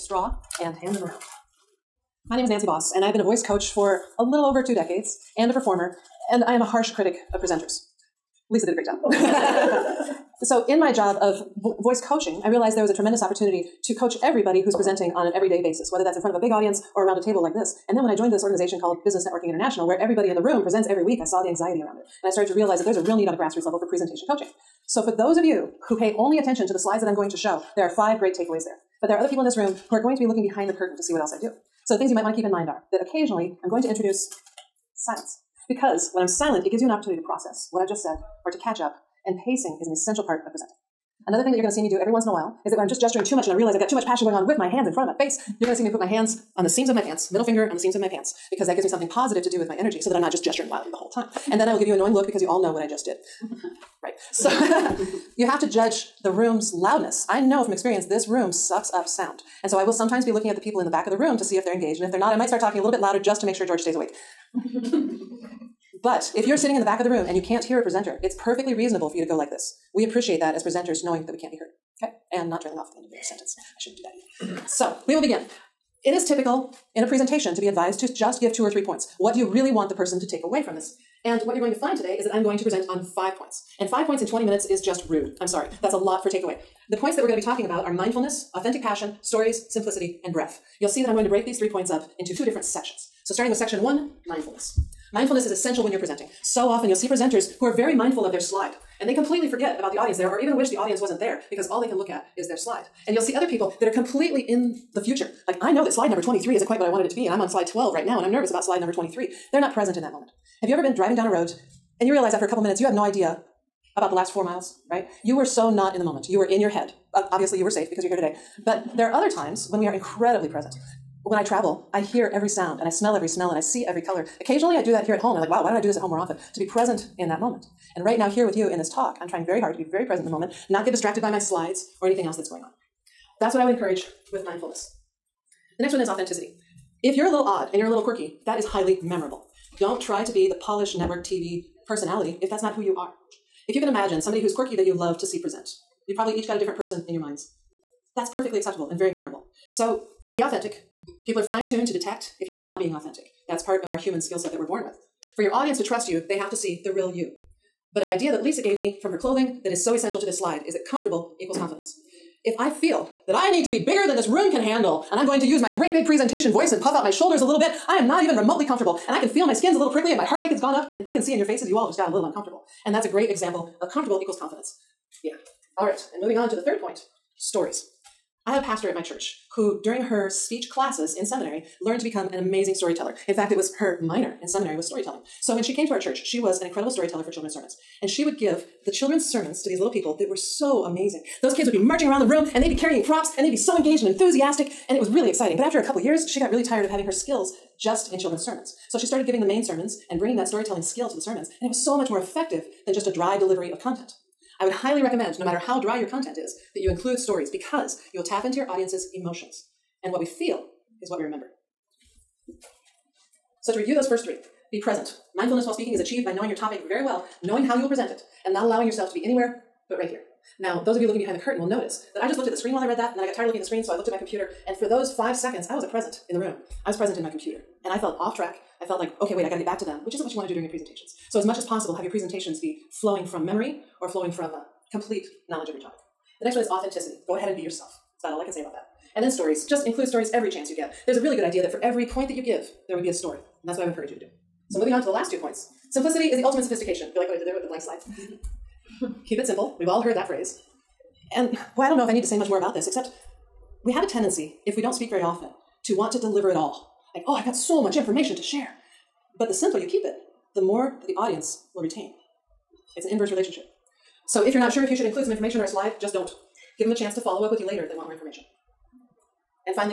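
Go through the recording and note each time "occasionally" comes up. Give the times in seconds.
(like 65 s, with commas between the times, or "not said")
33 s, 124 s.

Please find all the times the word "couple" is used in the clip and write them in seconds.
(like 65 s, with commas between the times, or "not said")
112 s, 195 s.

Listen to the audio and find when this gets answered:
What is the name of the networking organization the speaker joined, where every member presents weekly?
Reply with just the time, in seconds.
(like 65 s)
19 s.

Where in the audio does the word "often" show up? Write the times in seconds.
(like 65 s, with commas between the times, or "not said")
96 s, 126 s, 255 s.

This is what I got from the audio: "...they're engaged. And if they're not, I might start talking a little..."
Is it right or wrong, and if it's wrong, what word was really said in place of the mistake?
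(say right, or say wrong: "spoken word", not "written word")
right.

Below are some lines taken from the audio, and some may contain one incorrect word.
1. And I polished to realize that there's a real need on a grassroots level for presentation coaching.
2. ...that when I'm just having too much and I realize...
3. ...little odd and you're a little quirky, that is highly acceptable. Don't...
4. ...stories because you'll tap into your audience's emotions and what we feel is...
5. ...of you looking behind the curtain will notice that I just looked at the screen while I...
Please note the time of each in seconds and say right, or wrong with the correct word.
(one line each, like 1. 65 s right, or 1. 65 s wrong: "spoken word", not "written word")
1. 22 s wrong: "started", not "polished"
2. 42 s wrong: "gesturing", not "having"
3. 137 s wrong: "memorable", not "acceptable"
4. 207 s right
5. 220 s right.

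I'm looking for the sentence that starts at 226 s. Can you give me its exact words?
I was present in my computer.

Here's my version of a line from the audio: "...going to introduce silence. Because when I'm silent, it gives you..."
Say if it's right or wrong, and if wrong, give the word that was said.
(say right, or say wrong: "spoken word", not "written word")
right.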